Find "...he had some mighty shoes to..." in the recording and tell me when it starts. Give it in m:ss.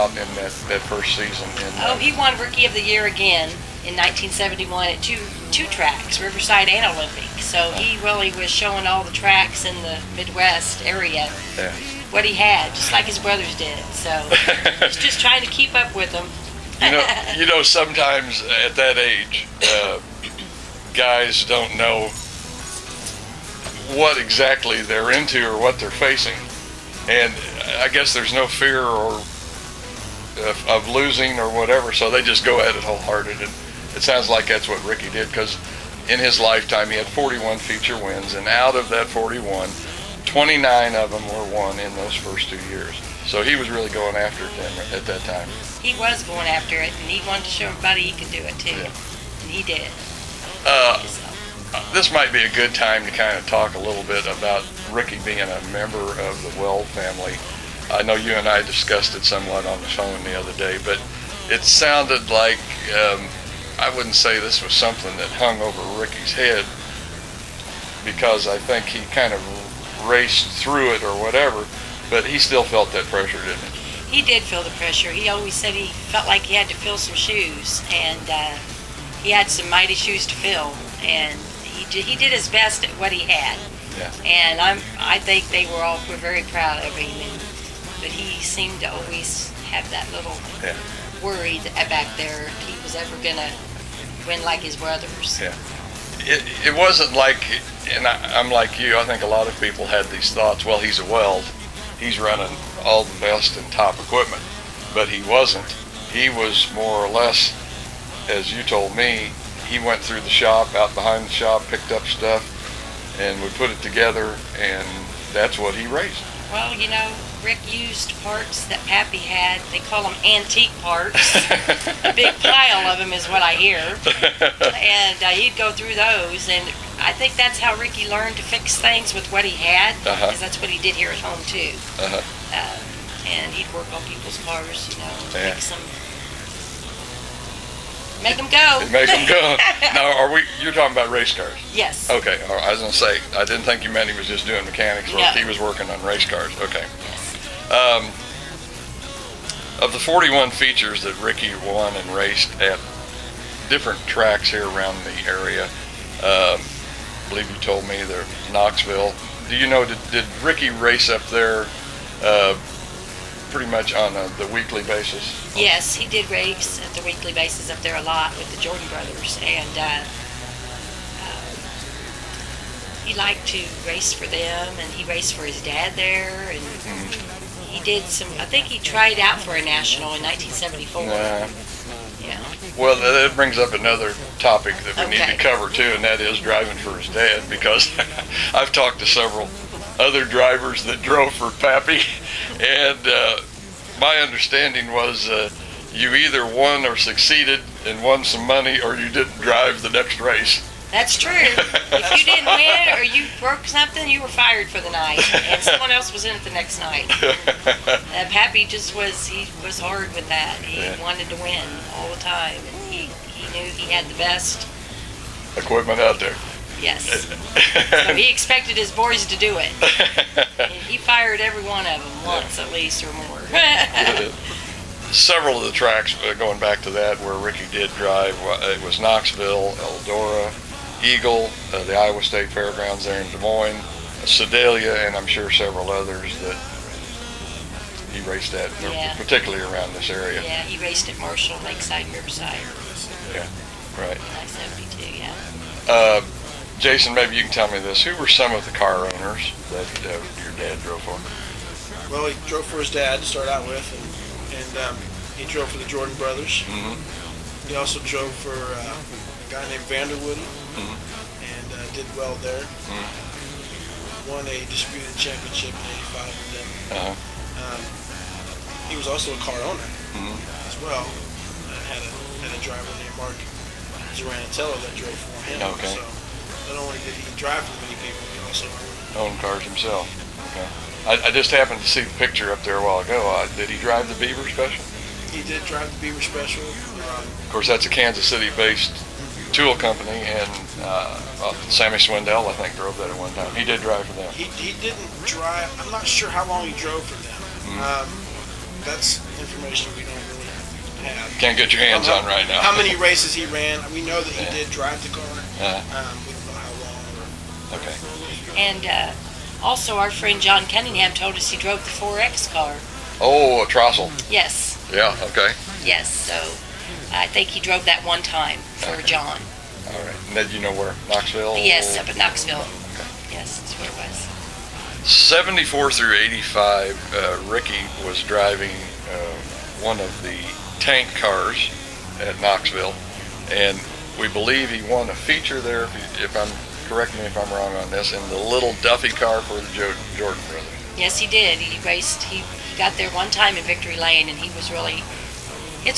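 1:19.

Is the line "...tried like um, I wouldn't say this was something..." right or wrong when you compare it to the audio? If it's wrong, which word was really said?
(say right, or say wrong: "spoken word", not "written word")
wrong: "sounded", not "tried".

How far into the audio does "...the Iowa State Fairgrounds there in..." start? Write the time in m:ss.
3:51.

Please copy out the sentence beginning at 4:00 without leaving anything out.
Yeah, he raced at Marshall, Lakeside, Riverside.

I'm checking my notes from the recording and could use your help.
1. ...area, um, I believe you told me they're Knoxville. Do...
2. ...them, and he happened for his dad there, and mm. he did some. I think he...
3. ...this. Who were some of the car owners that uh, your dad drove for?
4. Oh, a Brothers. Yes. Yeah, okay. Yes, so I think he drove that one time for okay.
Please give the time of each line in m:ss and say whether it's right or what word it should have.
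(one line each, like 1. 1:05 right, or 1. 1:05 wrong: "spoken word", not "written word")
1. 2:35 right
2. 2:54 wrong: "raced", not "happened"
3. 4:07 right
4. 5:13 wrong: "Trossel", not "Brothers".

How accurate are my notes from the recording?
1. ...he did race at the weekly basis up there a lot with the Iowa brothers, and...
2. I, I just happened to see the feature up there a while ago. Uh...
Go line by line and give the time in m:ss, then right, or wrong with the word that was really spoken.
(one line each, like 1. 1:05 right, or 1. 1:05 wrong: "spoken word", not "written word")
1. 2:45 wrong: "Jordan", not "Iowa"
2. 4:41 wrong: "picture", not "feature".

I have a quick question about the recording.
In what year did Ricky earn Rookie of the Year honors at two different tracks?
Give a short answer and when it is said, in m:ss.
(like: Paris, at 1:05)
1971, at 0:03.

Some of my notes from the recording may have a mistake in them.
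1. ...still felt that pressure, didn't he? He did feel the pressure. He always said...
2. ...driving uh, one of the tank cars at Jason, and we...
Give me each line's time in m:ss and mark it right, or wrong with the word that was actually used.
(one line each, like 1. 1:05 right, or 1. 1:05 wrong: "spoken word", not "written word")
1. 1:12 right
2. 5:28 wrong: "Knoxville", not "Jason".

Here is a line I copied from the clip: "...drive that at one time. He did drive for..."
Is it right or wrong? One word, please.
wrong.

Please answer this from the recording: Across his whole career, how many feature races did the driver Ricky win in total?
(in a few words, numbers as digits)
41.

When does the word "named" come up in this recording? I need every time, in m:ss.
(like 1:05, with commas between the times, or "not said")
4:19, 4:33.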